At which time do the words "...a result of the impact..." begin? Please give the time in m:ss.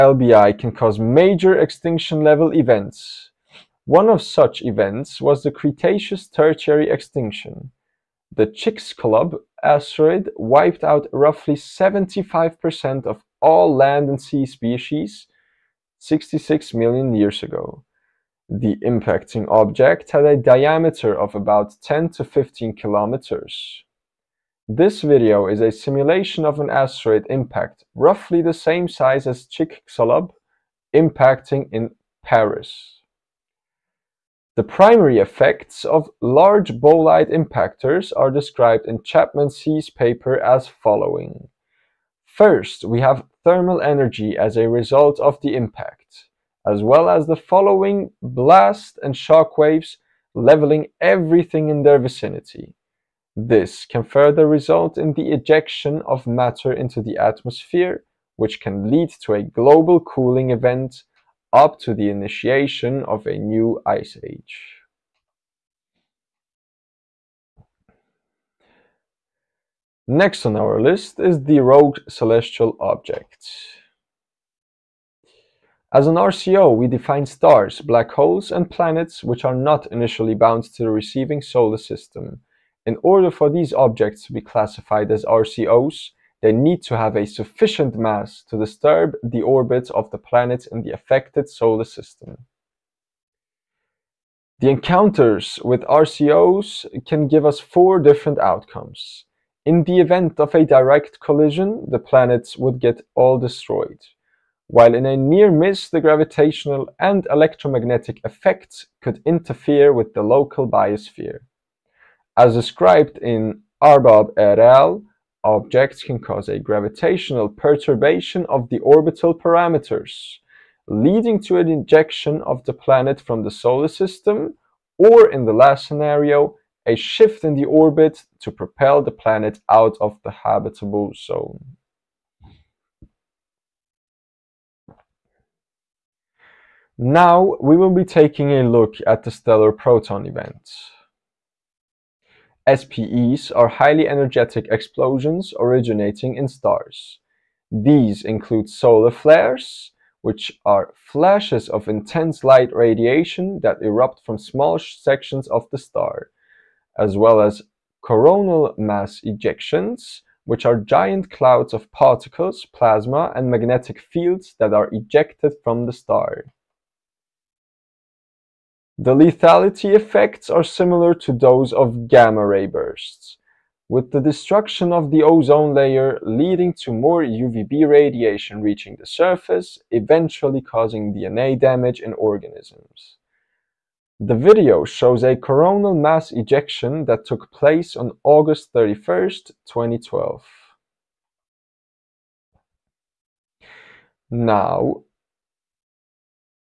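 0:44.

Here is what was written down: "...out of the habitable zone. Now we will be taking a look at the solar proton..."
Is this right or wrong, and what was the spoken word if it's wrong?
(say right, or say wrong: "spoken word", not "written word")
wrong: "stellar", not "solar".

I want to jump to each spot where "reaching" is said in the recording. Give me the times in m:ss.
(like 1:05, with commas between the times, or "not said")
2:58.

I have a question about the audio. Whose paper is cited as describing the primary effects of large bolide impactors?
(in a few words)
Chapman C.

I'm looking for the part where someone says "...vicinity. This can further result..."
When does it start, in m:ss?
0:51.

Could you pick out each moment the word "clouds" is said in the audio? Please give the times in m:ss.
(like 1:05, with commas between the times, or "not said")
2:41.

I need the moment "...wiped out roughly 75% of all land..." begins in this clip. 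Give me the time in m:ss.
0:10.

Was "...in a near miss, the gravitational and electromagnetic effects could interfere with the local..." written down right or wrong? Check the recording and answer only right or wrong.
right.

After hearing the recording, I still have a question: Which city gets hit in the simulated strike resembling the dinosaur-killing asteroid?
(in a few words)
Paris.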